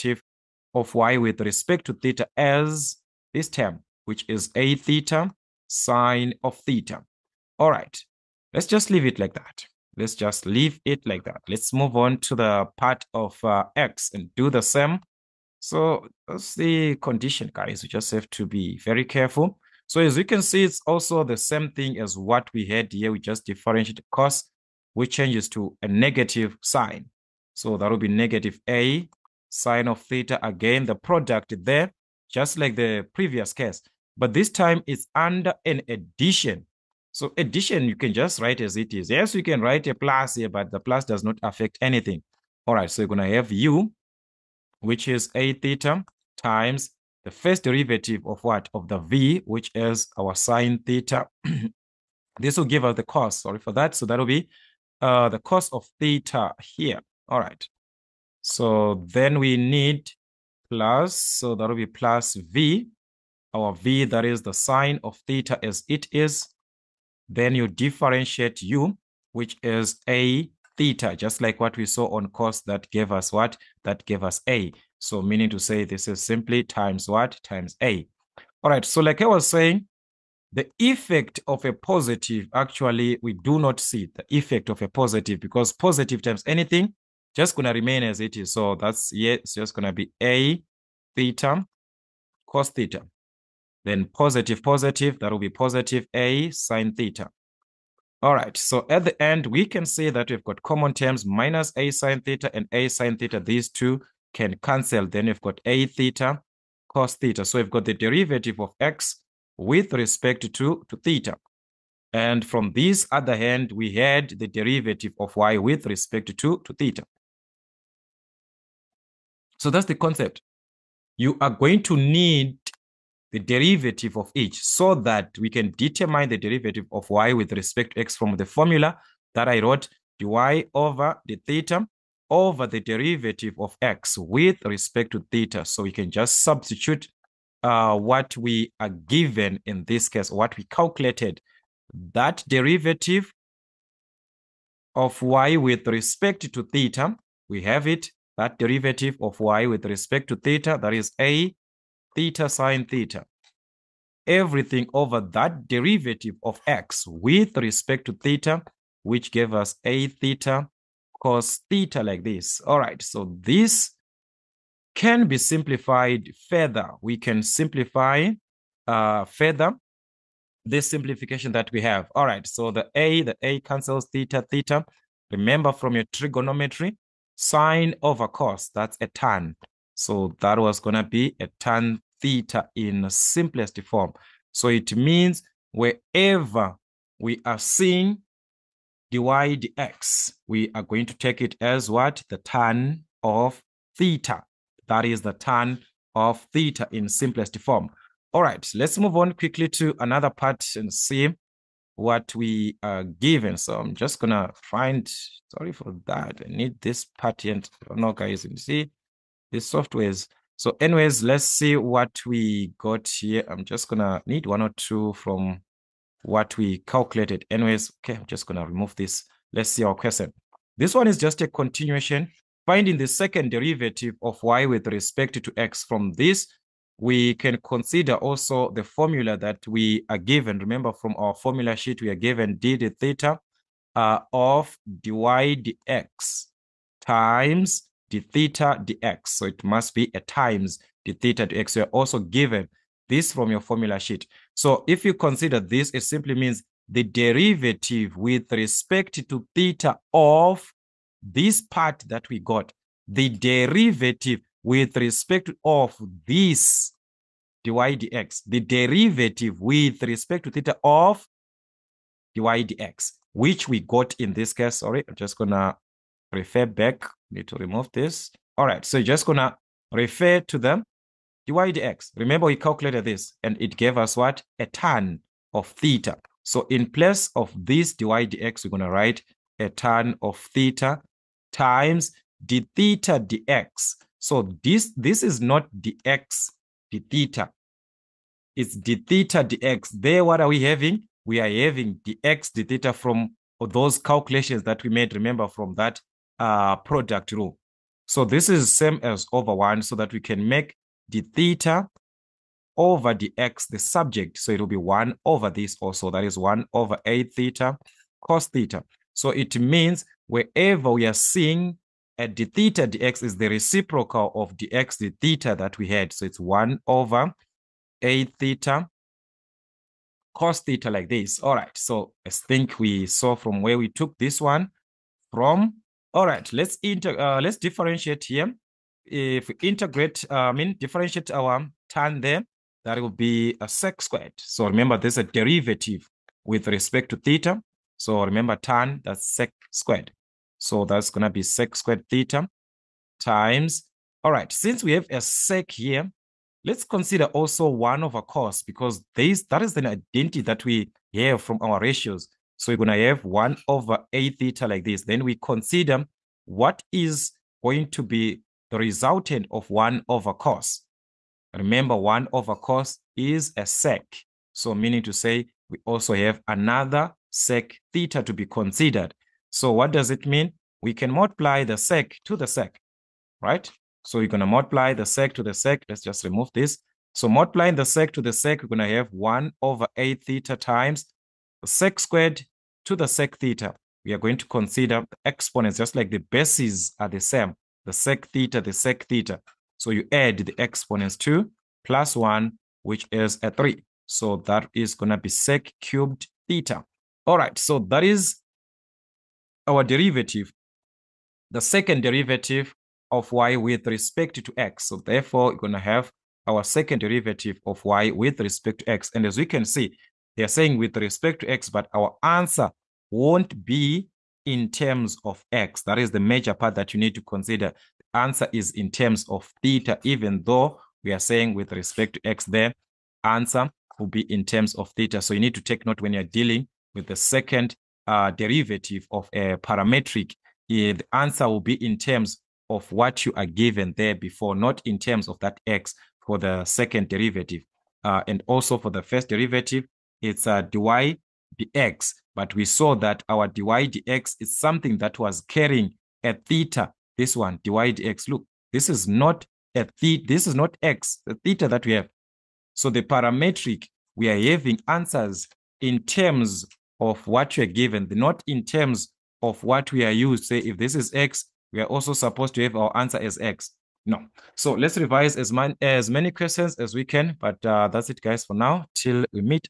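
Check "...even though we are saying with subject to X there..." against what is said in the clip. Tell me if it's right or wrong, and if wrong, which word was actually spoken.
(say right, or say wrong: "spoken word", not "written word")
wrong: "respect", not "subject".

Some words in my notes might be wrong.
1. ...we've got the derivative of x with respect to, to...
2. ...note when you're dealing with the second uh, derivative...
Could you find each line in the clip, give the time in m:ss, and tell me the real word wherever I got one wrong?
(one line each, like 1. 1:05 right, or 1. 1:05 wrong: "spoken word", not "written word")
1. 1:47 right
2. 7:05 right.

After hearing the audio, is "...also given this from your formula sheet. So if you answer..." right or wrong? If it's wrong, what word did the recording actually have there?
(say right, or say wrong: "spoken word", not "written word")
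wrong: "consider", not "answer".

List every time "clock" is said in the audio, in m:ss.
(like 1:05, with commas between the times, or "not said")
not said.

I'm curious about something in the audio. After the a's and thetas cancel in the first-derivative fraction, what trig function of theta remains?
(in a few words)
tan theta.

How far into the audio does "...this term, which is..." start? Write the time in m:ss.
0:03.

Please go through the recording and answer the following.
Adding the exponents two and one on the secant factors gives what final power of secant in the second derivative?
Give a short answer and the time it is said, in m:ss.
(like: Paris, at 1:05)
sec cubed theta, at 6:35.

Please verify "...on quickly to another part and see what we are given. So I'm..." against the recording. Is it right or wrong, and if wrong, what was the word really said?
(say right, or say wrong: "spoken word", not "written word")
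right.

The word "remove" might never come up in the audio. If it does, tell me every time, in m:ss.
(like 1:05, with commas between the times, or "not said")
3:38, 4:27, 6:16.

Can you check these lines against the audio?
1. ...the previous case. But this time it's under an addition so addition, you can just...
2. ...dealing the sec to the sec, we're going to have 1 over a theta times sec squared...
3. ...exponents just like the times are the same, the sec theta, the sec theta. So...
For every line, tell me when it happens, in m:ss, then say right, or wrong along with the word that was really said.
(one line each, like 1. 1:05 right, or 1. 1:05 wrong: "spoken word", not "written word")
1. 0:32 right
2. 6:17 wrong: "multiplying", not "dealing"
3. 6:25 wrong: "bases", not "times".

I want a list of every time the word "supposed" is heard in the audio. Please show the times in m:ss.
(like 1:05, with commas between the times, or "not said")
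7:42.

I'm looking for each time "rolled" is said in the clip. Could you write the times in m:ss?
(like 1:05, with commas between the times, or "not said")
not said.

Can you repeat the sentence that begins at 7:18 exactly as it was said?
Uh, and also for the first derivative, it's a dy dx.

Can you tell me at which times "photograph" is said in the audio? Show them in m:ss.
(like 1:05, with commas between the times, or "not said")
not said.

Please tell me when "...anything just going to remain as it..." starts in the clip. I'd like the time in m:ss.
1:26.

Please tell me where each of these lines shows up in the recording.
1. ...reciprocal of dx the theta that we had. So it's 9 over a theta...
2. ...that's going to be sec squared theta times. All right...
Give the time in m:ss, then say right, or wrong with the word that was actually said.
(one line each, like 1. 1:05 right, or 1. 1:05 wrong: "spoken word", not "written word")
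1. 5:13 wrong: "1", not "9"
2. 5:40 right.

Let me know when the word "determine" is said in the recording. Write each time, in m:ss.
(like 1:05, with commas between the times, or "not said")
2:05.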